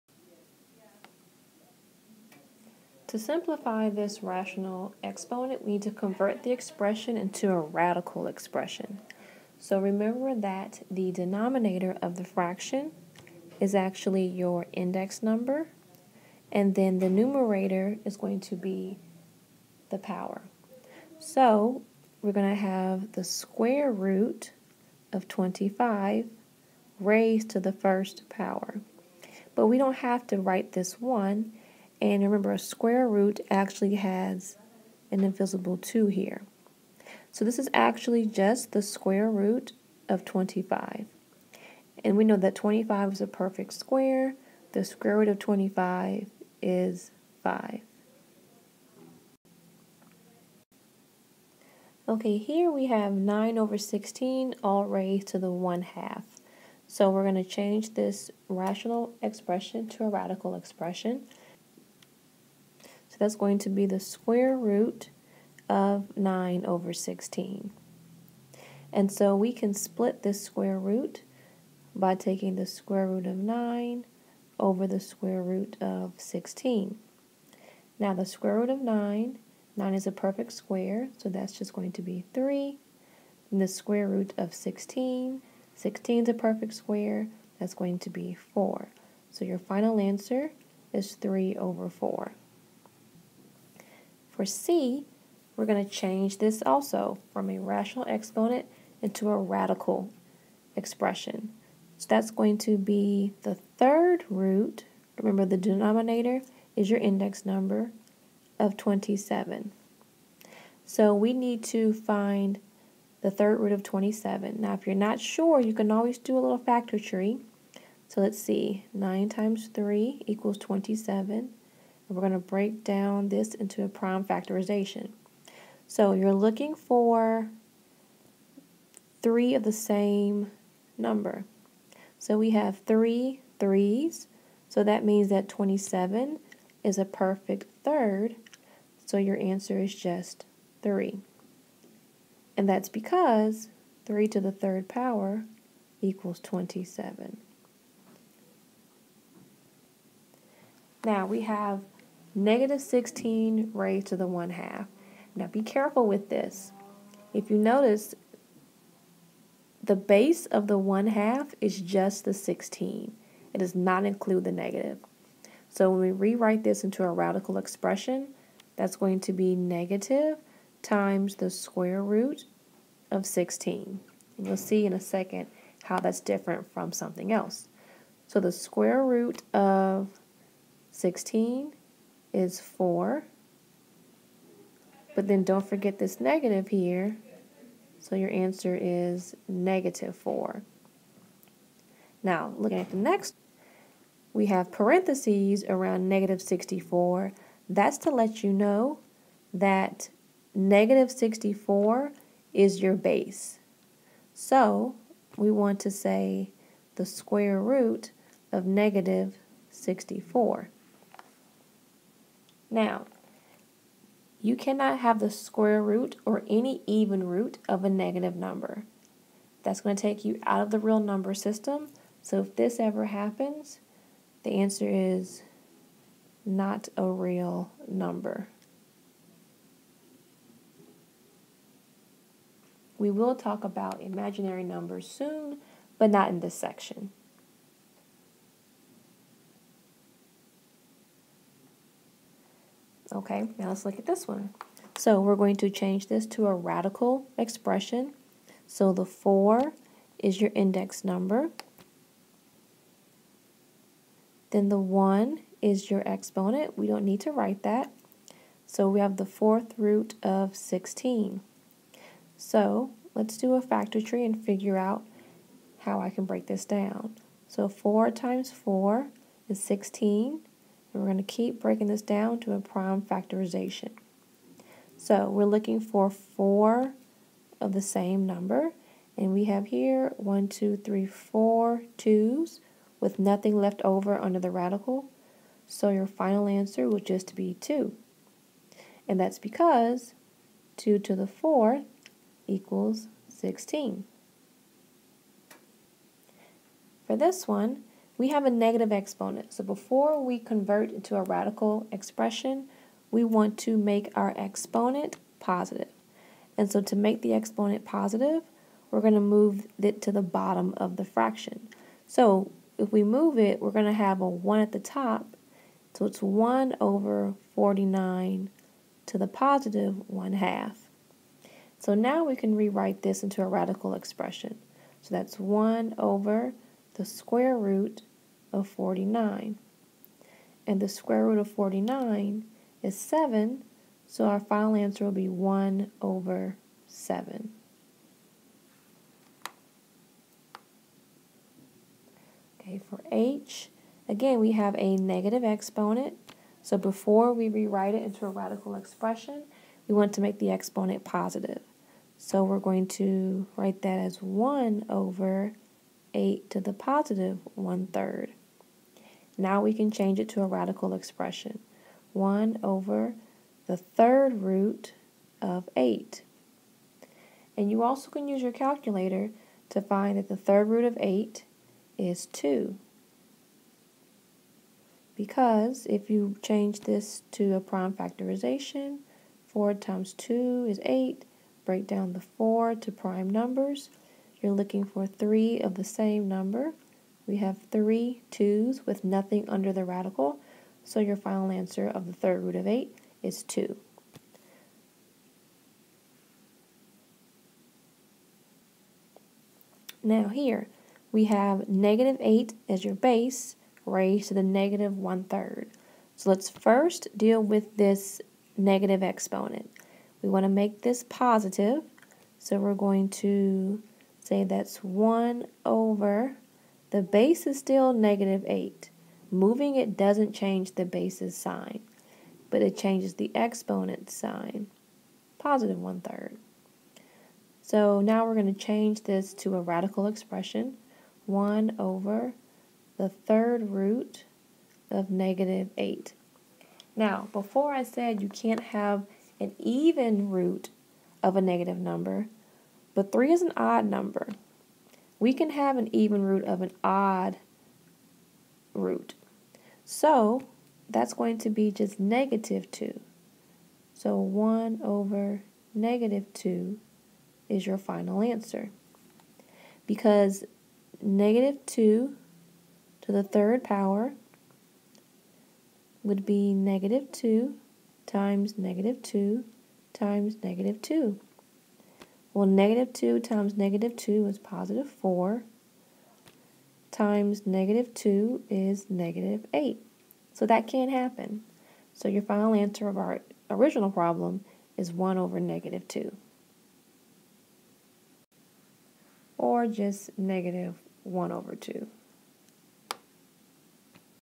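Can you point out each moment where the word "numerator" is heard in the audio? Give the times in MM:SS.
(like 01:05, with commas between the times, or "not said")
00:17.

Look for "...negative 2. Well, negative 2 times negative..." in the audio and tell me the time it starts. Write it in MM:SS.
07:50.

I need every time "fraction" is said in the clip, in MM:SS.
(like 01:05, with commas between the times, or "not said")
00:12, 05:11.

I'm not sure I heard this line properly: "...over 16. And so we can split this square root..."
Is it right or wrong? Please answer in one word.
right.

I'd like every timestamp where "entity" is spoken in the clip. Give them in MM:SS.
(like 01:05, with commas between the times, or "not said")
not said.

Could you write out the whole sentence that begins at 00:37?
So this is actually just the square root of 25.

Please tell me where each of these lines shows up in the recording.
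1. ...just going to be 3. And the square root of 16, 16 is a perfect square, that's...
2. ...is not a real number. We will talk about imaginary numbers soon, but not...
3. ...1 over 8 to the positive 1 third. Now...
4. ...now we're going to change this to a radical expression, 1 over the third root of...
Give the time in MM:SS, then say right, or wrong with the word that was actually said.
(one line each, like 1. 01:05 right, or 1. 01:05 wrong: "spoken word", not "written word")
1. 01:21 right
2. 03:44 right
3. 05:54 right
4. 07:08 right.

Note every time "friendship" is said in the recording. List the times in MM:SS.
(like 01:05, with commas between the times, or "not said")
not said.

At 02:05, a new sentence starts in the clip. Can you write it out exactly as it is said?
So you're looking for three of the same number.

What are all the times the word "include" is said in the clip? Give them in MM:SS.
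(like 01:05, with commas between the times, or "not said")
02:44.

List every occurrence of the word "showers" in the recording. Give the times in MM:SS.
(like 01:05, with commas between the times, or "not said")
not said.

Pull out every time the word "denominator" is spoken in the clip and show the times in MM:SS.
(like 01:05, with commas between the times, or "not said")
00:11, 01:45.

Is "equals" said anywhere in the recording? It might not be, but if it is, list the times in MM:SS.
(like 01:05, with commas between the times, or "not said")
02:00, 02:26, 04:52.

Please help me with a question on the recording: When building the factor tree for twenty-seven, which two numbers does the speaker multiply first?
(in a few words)
9 times 3.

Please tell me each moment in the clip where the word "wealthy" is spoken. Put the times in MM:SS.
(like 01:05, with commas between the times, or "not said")
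not said.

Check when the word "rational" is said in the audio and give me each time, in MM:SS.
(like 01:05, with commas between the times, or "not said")
00:04, 00:58, 01:37.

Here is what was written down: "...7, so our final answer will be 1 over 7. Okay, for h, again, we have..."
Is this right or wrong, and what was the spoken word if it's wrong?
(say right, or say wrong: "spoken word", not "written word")
right.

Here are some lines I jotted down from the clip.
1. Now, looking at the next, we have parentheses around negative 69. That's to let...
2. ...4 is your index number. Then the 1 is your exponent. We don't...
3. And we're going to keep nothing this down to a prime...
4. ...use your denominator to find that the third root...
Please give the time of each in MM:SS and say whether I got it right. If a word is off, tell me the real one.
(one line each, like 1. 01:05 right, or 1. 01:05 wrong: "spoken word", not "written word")
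1. 03:12 wrong: "64", not "69"
2. 04:09 right
3. 04:30 wrong: "breaking", not "nothing"
4. 06:08 wrong: "calculator", not "denominator".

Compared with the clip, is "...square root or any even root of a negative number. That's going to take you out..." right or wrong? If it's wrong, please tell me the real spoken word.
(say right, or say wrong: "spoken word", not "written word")
right.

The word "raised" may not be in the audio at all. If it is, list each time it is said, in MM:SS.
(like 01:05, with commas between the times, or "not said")
00:27, 00:54, 02:33, 06:43.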